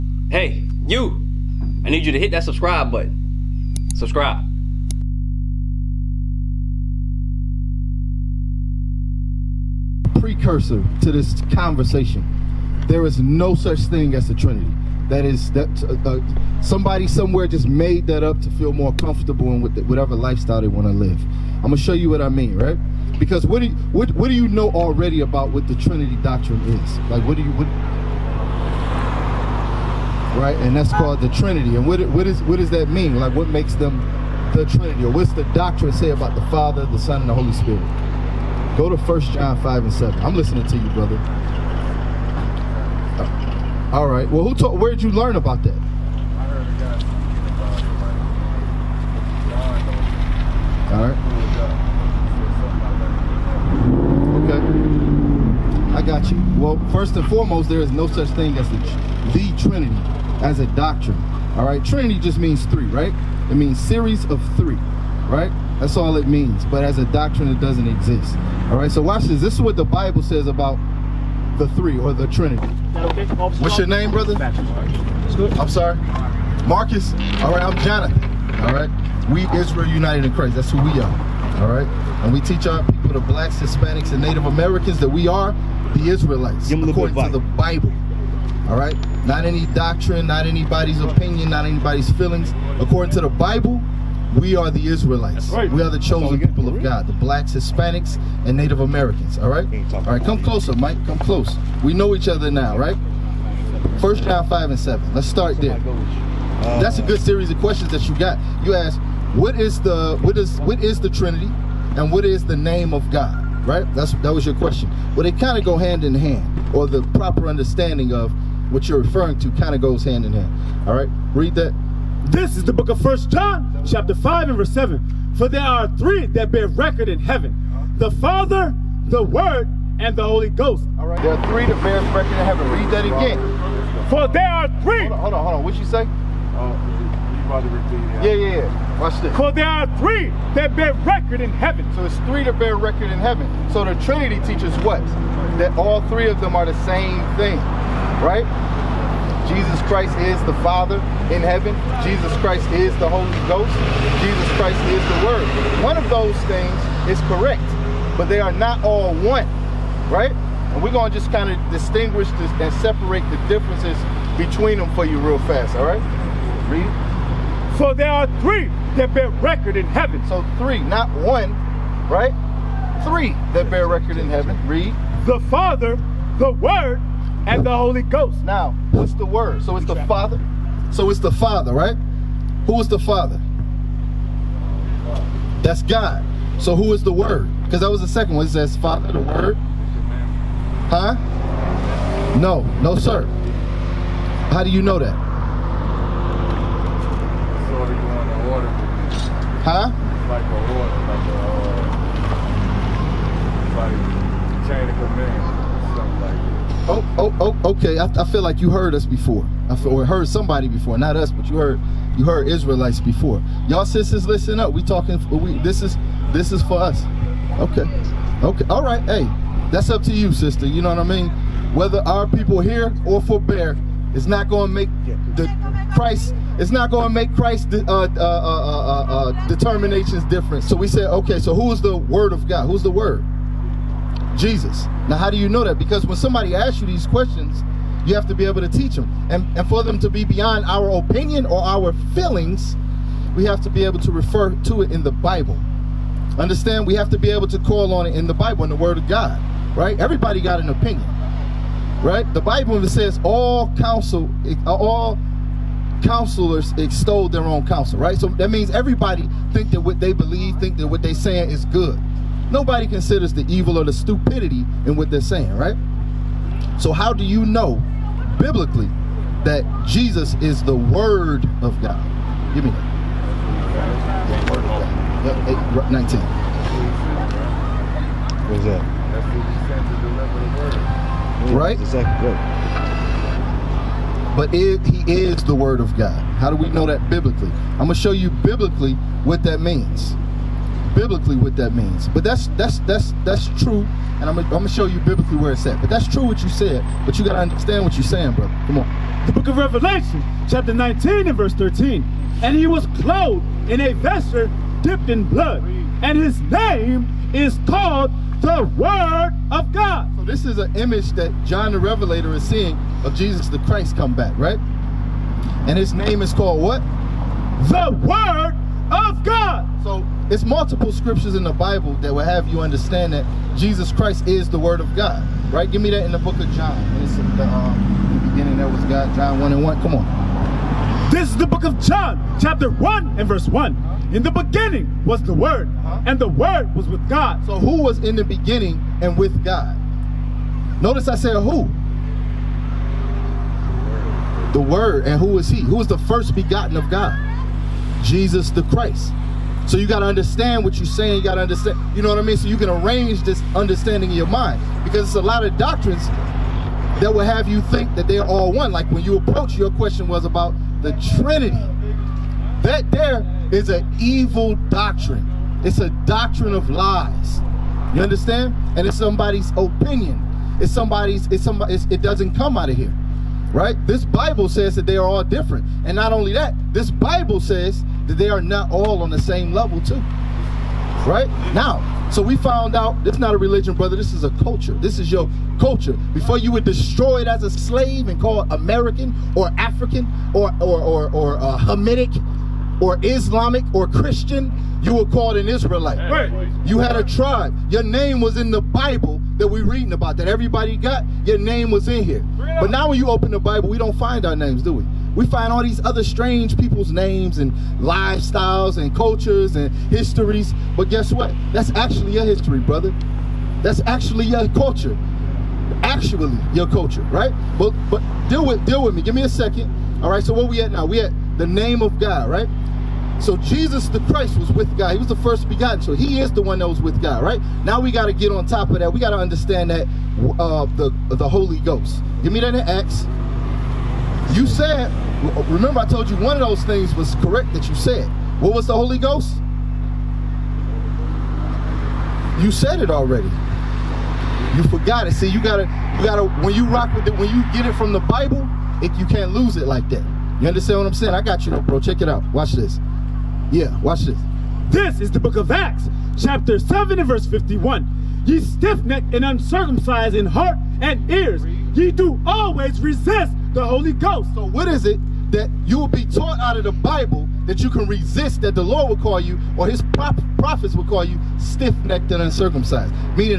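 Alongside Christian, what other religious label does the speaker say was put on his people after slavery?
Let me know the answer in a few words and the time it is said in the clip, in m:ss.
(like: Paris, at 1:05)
Islamic, at 6:33.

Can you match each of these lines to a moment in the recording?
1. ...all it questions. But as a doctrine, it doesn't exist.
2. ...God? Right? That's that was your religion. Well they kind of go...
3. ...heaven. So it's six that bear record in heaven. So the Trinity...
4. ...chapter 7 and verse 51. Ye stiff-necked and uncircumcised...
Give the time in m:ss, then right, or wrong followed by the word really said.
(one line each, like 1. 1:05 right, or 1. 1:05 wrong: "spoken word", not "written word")
1. 1:05 wrong: "means", not "questions"
2. 1:53 wrong: "question", not "religion"
3. 2:21 wrong: "three", not "six"
4. 7:36 right.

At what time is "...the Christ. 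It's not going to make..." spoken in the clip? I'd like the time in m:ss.
3:45.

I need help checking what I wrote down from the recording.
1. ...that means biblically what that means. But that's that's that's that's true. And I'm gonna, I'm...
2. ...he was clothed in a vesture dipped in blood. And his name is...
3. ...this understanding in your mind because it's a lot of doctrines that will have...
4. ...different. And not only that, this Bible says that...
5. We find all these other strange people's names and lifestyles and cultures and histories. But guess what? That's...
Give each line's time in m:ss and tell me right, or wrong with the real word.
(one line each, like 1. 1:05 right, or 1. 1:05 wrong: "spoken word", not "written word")
1. 4:49 right
2. 5:02 right
3. 5:53 right
4. 6:15 right
5. 6:45 right.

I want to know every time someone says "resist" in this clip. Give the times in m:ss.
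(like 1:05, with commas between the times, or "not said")
7:42, 7:47.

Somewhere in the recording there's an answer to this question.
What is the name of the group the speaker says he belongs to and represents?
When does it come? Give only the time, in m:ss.
1:19.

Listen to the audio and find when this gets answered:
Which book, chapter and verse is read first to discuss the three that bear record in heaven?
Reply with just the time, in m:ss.
1:44.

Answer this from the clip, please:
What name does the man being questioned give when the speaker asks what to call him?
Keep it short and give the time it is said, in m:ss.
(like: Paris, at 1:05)
Marcus, at 1:16.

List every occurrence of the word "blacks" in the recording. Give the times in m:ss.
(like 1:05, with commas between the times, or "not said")
1:23, 1:37.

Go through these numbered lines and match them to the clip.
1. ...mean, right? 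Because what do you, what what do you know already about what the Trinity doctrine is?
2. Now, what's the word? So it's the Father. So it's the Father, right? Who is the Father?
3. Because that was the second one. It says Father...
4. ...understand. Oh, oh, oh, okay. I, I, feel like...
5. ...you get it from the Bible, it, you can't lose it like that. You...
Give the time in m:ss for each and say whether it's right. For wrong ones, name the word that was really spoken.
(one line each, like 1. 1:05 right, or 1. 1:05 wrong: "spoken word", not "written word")
1. 0:22 right
2. 2:58 right
3. 3:07 right
4. 3:24 wrong: "command", not "understand"
5. 7:27 right.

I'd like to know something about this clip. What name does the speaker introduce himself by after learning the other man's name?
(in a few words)
Jonathan.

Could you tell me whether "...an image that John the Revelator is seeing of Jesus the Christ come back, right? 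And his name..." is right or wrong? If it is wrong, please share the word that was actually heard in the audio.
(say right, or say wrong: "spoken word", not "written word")
right.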